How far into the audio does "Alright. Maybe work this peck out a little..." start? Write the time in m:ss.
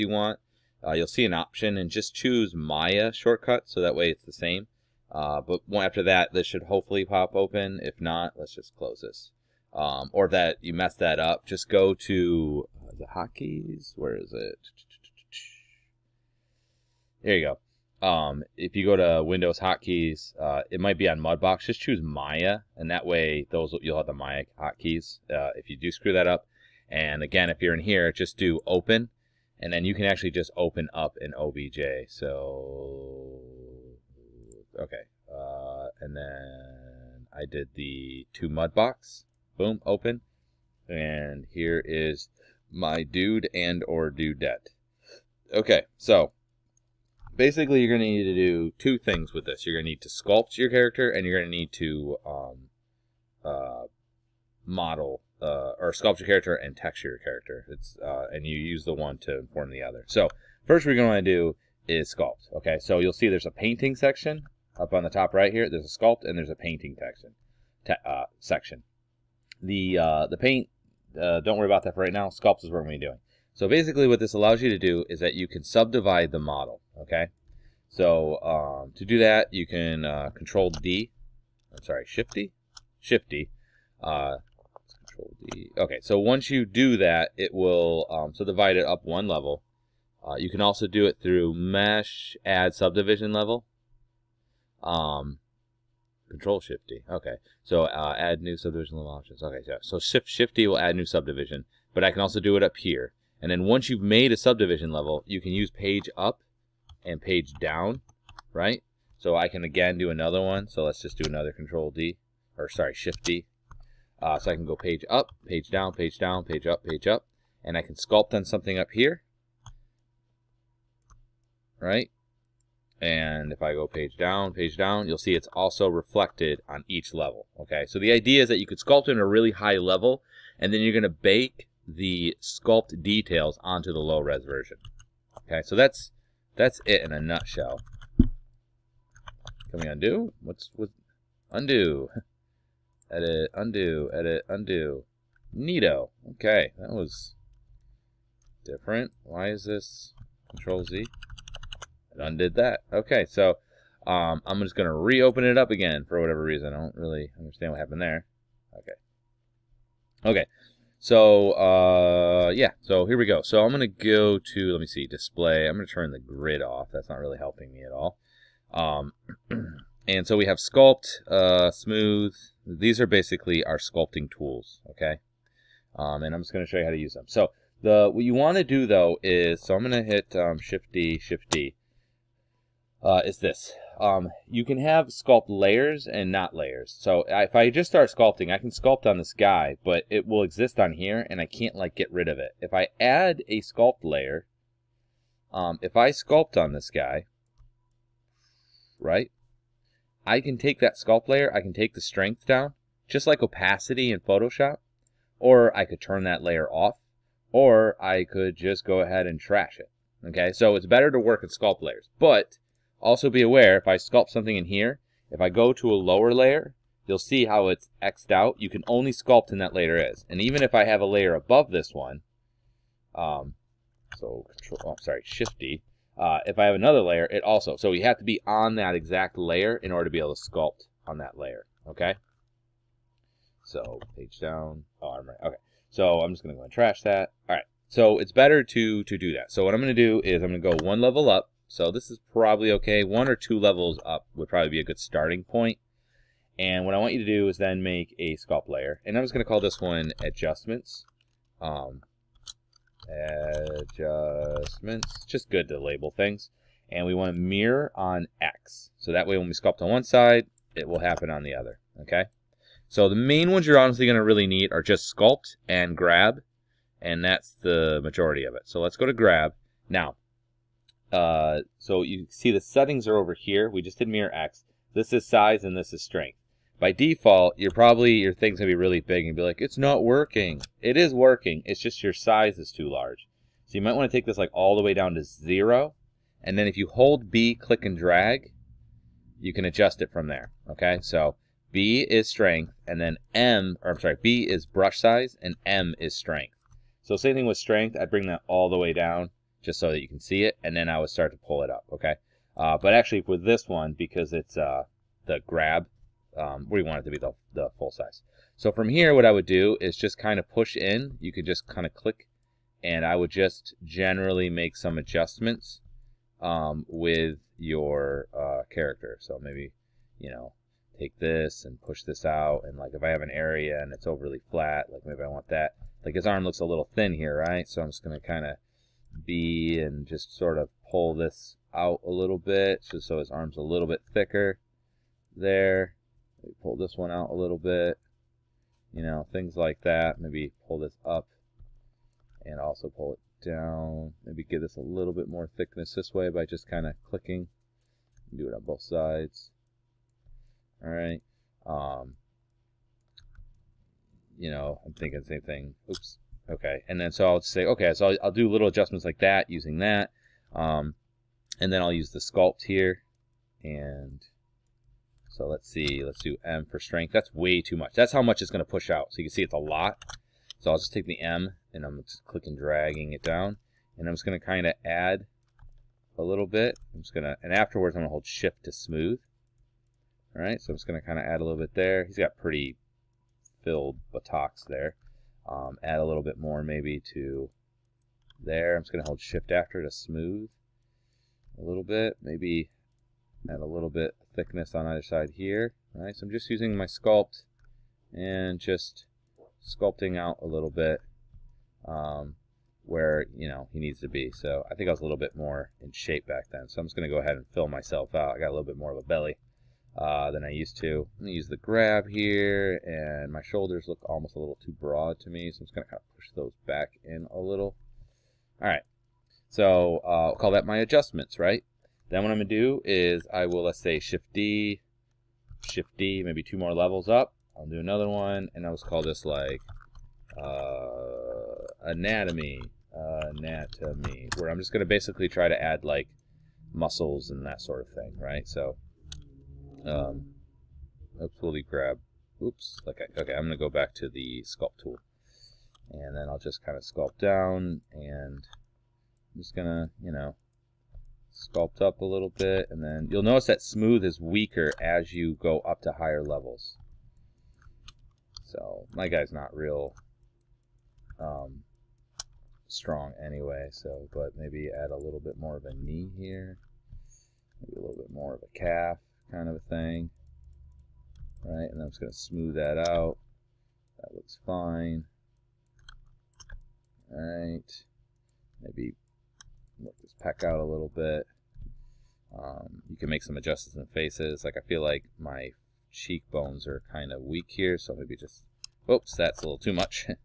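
7:57.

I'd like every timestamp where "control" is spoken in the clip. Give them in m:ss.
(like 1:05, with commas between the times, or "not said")
1:20, 1:25, 1:36, 1:51, 2:30, 3:44.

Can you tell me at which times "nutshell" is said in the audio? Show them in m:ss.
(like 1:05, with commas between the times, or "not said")
2:17.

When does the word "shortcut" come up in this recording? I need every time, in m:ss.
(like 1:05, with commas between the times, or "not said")
0:03.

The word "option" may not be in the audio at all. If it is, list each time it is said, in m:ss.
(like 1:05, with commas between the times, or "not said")
0:01, 1:39.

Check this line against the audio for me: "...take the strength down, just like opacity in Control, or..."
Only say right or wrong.
wrong.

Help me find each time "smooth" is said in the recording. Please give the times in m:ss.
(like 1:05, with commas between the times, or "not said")
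2:51, 6:18, 6:29, 7:33, 7:52.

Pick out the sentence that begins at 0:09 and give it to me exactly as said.
Um, or that you messed that up, just go to uh, the hotkeys.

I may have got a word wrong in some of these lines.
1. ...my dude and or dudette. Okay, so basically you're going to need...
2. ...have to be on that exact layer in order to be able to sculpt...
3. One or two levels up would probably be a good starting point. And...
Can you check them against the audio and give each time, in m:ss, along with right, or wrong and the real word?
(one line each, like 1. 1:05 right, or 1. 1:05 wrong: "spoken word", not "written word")
1. 0:42 right
2. 3:48 right
3. 4:03 right.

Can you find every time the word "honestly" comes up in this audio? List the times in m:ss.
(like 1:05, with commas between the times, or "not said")
4:23.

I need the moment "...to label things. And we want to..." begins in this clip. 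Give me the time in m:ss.
4:15.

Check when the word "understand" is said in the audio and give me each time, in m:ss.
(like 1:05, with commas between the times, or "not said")
2:37.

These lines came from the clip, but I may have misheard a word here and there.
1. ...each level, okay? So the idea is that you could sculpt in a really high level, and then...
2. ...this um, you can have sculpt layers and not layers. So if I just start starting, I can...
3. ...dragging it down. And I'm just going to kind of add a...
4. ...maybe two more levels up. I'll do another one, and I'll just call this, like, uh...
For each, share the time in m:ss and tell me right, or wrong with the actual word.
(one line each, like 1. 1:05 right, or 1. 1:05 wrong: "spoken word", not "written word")
1. 2:06 right
2. 3:03 wrong: "sculpting", not "starting"
3. 6:12 right
4. 7:06 right.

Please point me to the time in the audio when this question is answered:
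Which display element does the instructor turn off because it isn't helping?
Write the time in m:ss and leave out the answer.
2:46.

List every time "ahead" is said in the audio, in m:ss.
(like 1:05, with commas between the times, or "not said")
3:29, 6:47.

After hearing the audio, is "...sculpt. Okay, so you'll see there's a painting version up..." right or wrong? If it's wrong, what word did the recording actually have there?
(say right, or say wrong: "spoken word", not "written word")
wrong: "section", not "version".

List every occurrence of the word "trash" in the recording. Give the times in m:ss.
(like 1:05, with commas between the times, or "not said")
3:29, 3:56.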